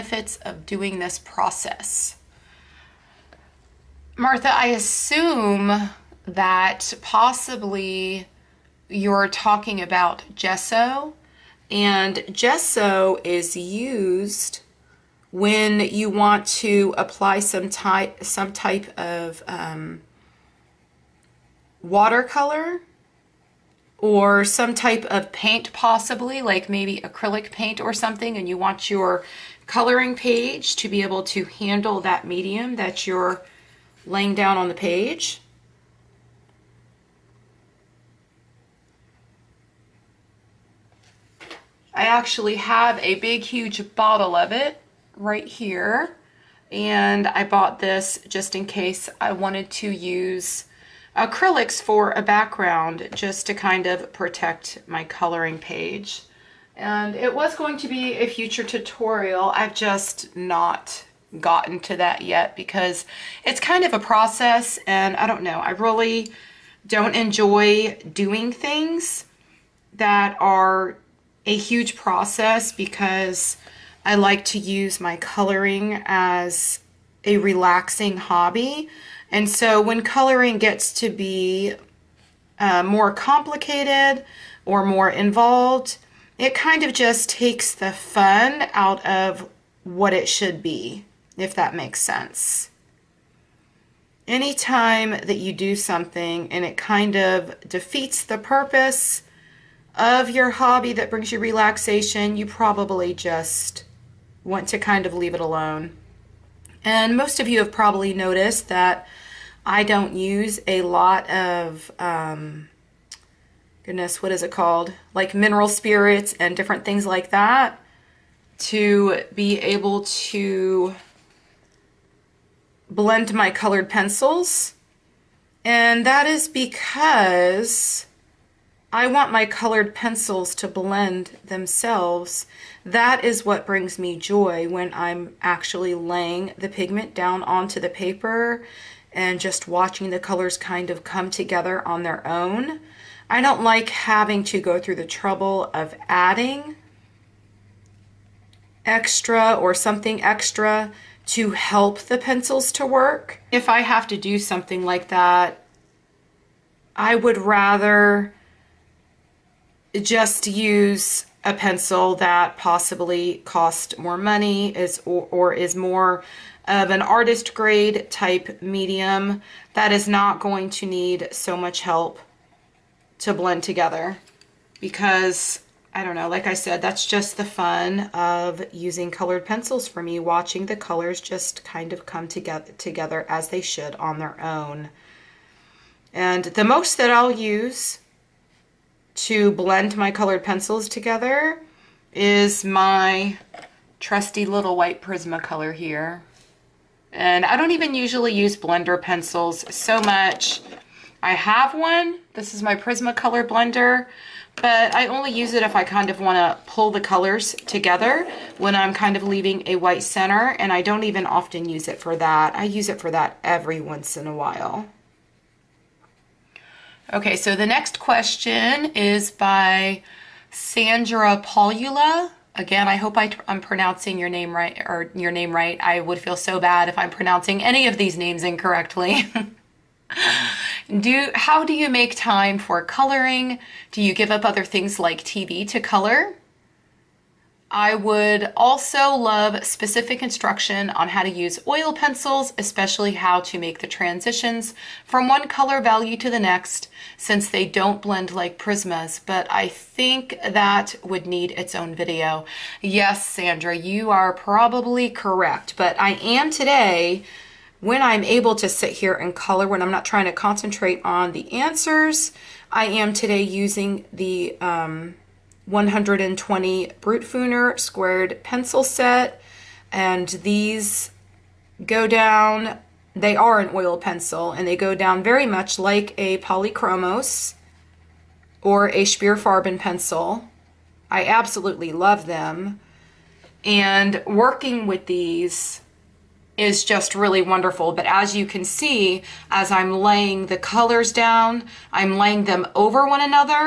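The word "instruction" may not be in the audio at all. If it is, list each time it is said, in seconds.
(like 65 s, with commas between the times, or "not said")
240 s.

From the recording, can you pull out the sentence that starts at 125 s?
And that is because I want my colored pencils to blend themselves.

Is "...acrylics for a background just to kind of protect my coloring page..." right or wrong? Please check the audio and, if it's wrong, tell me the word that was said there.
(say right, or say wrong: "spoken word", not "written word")
right.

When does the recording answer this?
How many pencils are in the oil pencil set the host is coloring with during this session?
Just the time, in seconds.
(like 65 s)
265 s.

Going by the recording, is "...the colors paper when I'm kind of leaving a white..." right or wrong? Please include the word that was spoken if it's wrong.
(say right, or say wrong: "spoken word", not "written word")
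wrong: "together", not "paper".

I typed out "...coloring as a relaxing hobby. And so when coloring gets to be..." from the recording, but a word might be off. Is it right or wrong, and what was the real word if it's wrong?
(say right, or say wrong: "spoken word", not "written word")
right.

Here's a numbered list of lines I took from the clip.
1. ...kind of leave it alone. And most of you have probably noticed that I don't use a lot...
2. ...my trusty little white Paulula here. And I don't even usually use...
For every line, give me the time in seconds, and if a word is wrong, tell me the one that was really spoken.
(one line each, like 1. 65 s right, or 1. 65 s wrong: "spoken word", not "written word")
1. 104 s right
2. 192 s wrong: "Prismacolor", not "Paulula".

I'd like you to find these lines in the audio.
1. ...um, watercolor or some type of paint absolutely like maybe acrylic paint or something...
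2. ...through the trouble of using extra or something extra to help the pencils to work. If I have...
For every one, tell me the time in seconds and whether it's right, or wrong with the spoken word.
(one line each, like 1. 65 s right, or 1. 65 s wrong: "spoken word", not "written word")
1. 19 s wrong: "possibly", not "absolutely"
2. 144 s wrong: "adding", not "using".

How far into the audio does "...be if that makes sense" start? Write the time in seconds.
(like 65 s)
90 s.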